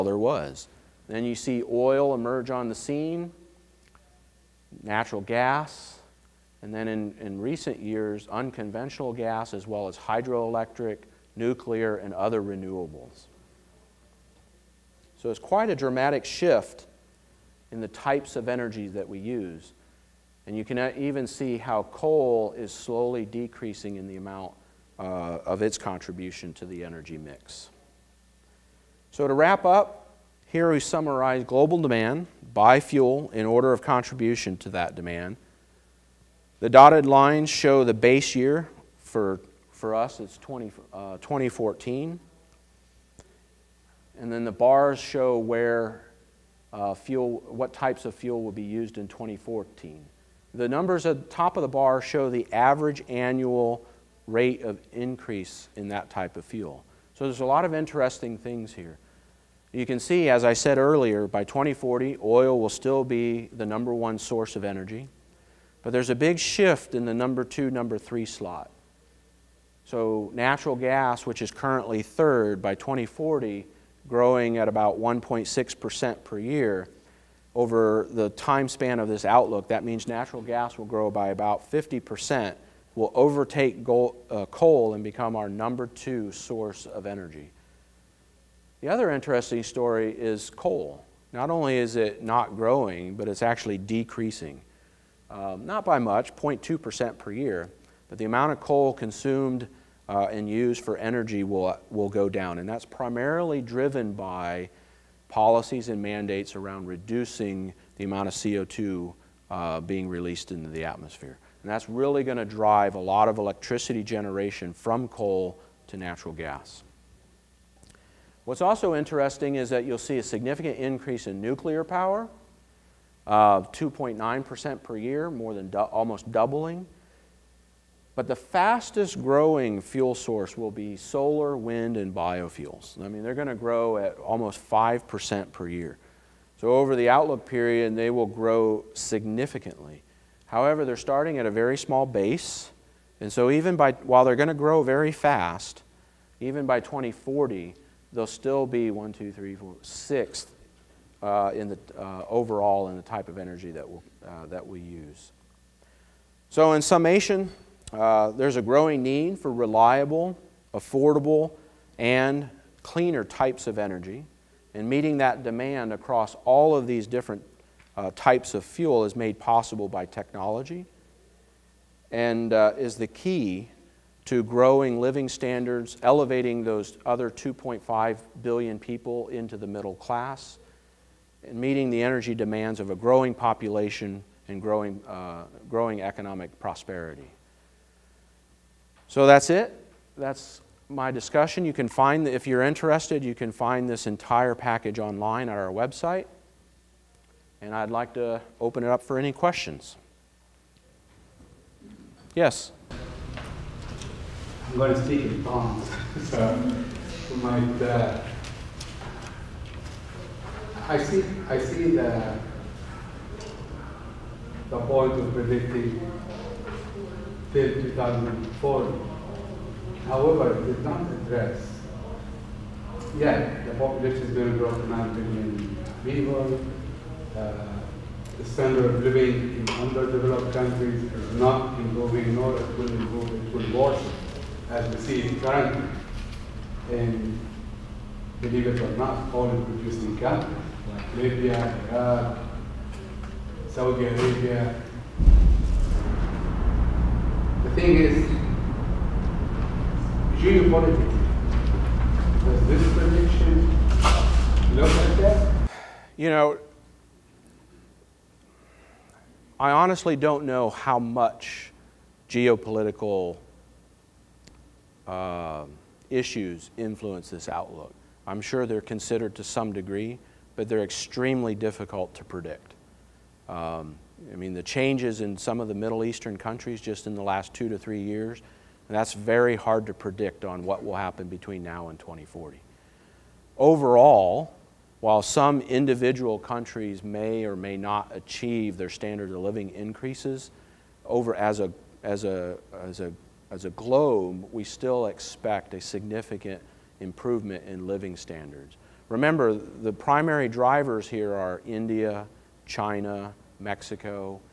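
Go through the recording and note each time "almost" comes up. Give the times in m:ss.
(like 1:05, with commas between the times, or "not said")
2:05, 2:14.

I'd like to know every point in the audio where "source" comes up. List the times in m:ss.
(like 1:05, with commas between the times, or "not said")
1:04, 1:26, 2:10.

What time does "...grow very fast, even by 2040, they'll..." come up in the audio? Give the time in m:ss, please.
2:24.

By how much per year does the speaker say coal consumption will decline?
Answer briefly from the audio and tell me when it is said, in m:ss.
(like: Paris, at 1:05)
0.2%, at 1:36.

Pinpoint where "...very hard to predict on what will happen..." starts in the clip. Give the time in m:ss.
4:39.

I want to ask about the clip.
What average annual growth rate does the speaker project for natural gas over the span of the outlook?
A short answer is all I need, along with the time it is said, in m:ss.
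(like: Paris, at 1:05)
1.6%, at 1:14.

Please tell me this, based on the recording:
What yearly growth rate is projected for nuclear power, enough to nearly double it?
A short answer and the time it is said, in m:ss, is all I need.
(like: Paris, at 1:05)
2.9%, at 2:03.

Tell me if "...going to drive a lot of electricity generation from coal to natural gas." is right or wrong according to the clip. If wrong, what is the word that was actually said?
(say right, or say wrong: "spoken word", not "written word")
right.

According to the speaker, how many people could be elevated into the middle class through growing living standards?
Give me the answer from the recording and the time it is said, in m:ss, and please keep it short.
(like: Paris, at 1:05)
2.5 billion, at 2:57.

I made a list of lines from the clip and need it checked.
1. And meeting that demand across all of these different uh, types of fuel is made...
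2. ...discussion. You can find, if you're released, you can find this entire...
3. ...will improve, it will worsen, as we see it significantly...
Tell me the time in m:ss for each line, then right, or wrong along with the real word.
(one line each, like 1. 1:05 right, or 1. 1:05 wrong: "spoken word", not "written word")
1. 2:44 right
2. 3:11 wrong: "interested", not "released"
3. 3:52 wrong: "currently", not "significantly".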